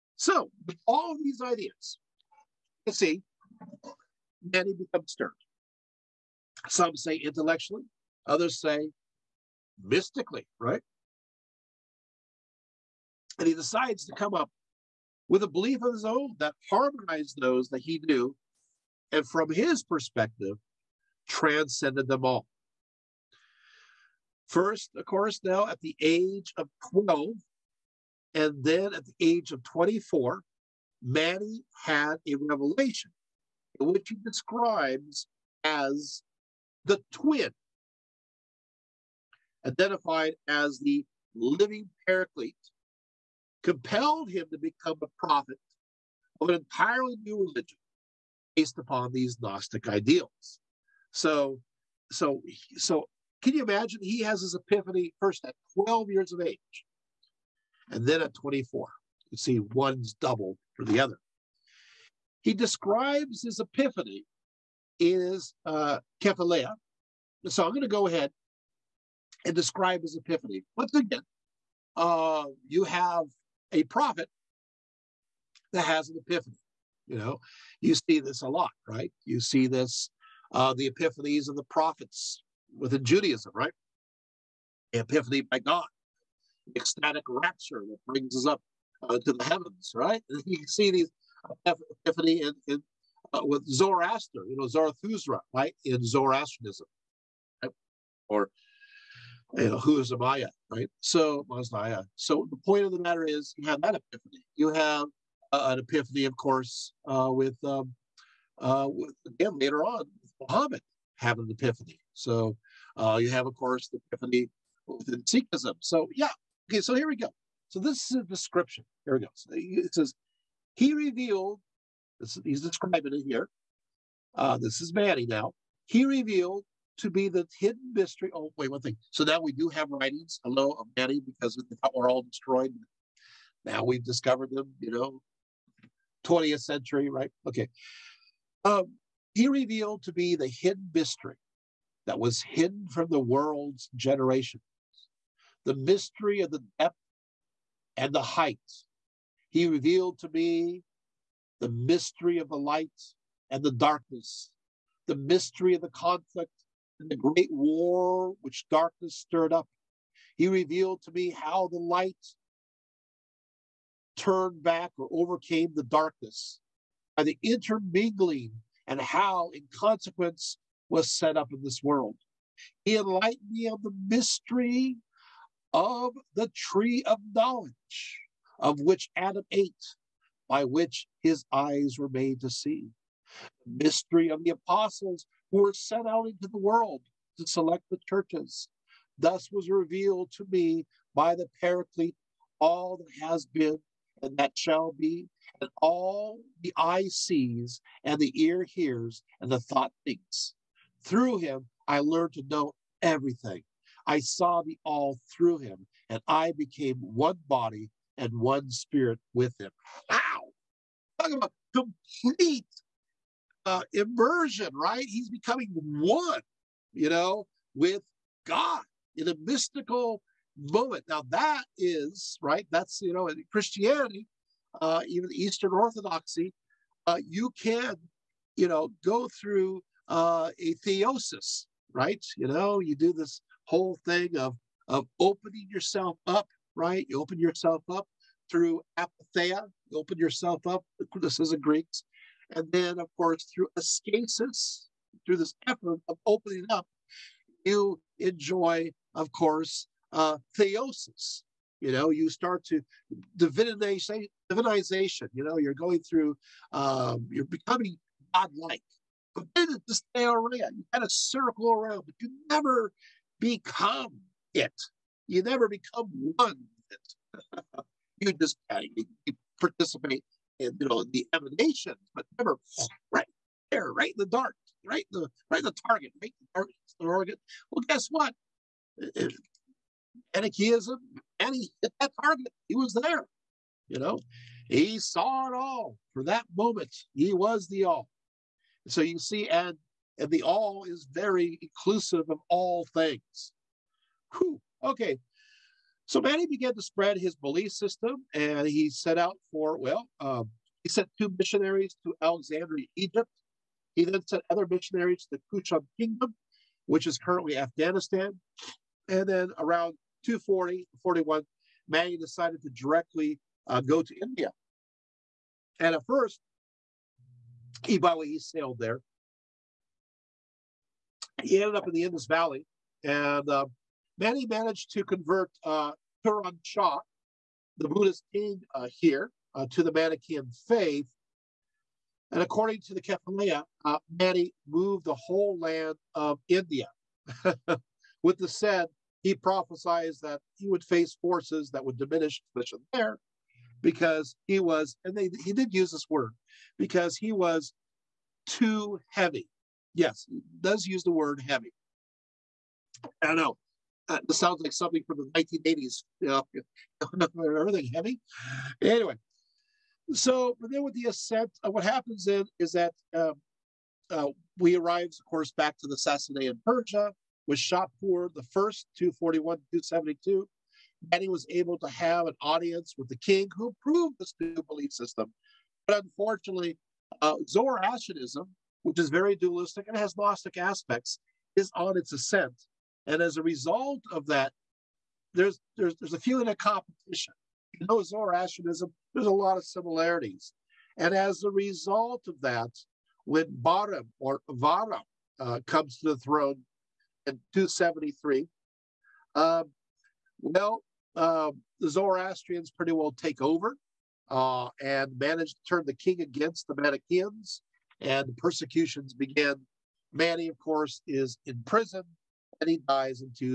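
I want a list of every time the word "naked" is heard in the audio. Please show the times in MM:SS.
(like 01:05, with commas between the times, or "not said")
not said.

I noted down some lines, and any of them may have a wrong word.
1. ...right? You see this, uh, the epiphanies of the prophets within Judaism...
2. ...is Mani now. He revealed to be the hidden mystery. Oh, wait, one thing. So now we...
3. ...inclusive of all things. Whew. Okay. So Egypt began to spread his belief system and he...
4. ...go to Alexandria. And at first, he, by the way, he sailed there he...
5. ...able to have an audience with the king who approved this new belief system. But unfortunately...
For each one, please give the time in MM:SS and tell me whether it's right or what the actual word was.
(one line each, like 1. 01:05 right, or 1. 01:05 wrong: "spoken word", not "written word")
1. 01:18 right
2. 02:04 right
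3. 04:51 wrong: "Mani", not "Egypt"
4. 05:13 wrong: "India", not "Alexandria"
5. 06:11 right.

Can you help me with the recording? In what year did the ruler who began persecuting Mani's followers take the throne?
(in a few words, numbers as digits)
273.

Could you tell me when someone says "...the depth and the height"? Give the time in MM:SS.
02:26.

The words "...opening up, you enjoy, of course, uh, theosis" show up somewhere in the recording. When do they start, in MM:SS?
04:06.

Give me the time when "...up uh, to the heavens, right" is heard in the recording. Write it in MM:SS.
01:28.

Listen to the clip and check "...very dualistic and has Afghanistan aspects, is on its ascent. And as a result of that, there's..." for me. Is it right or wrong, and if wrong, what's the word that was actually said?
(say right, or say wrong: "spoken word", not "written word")
wrong: "Gnostic", not "Afghanistan".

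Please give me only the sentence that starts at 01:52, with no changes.
So uh, you have, of course, the epiphany within Sikhism.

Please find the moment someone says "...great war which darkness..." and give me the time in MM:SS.
02:37.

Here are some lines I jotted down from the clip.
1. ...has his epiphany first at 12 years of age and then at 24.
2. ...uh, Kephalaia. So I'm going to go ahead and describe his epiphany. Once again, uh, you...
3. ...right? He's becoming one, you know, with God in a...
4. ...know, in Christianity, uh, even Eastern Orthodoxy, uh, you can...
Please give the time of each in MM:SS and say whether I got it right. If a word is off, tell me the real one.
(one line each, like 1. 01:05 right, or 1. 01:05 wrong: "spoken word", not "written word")
1. 00:54 right
2. 01:05 right
3. 03:34 right
4. 03:43 right.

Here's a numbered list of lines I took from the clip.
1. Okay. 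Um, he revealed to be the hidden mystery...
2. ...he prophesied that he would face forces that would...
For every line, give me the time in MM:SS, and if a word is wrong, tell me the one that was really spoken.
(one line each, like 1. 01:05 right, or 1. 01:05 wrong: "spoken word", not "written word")
1. 02:17 right
2. 05:39 right.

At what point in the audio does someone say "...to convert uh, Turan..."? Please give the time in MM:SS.
05:24.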